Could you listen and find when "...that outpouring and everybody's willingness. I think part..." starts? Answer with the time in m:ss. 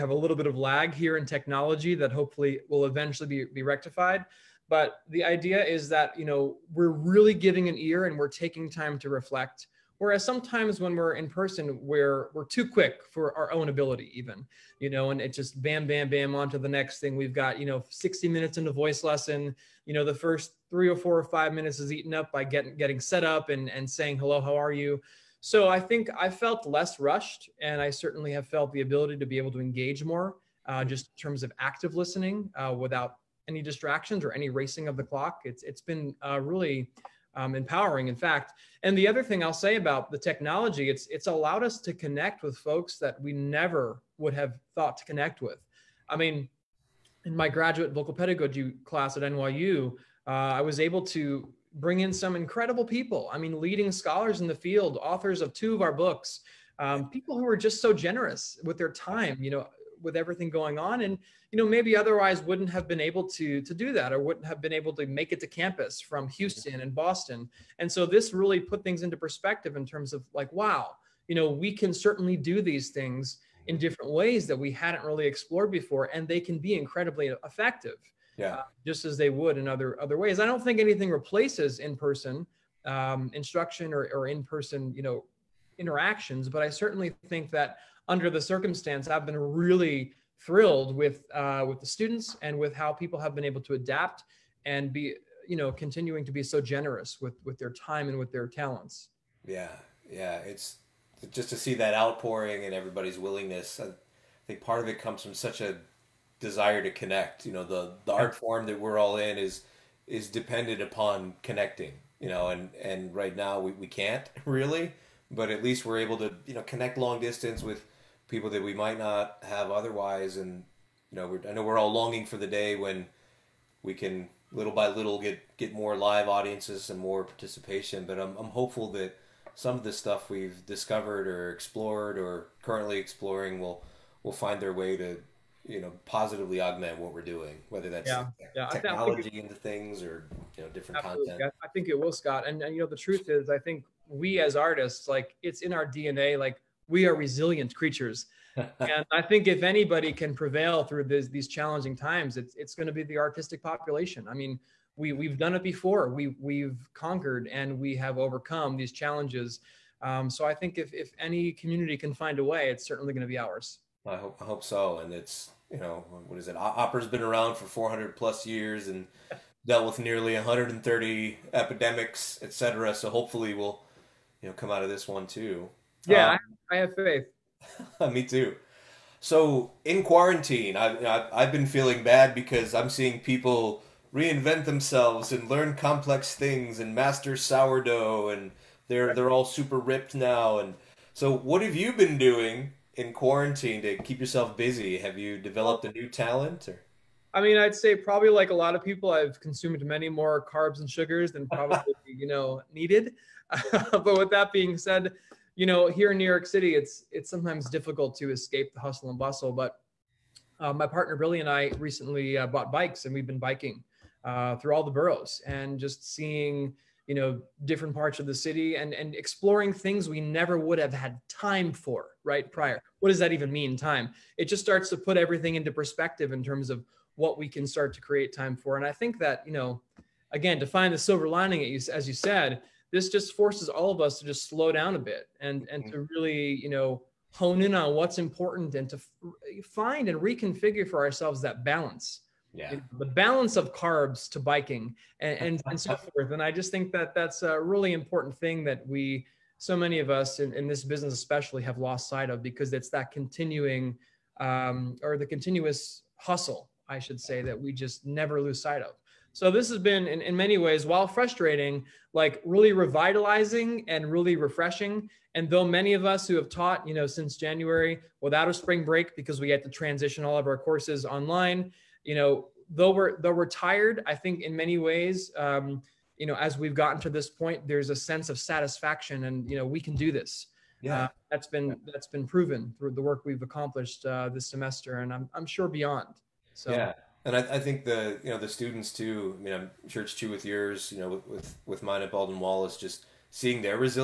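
1:41.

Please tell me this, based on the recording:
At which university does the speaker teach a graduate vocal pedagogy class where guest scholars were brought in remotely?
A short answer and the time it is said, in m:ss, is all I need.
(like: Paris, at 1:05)
NYU, at 0:49.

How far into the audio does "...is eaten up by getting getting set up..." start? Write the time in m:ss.
0:21.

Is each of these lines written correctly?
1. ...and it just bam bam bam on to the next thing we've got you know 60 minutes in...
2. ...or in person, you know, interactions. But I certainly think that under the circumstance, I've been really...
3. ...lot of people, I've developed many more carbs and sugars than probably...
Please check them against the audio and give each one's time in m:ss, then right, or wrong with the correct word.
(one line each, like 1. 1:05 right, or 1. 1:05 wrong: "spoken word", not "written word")
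1. 0:15 right
2. 1:24 right
3. 3:18 wrong: "consumed", not "developed".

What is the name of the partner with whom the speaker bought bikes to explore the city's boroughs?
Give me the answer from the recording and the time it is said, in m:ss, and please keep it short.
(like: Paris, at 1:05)
Billy, at 3:31.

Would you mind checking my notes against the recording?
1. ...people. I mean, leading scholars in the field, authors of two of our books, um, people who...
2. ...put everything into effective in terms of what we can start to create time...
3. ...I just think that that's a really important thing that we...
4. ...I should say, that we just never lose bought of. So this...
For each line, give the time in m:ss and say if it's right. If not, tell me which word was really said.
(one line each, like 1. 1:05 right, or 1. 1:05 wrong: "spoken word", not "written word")
1. 0:52 right
2. 3:44 wrong: "perspective", not "effective"
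3. 4:06 right
4. 4:16 wrong: "sight", not "bought".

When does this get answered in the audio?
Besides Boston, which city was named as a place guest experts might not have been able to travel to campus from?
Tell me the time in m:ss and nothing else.
1:06.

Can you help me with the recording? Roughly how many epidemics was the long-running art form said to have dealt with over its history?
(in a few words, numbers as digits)
130.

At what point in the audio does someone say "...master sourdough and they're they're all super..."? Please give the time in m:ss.
3:06.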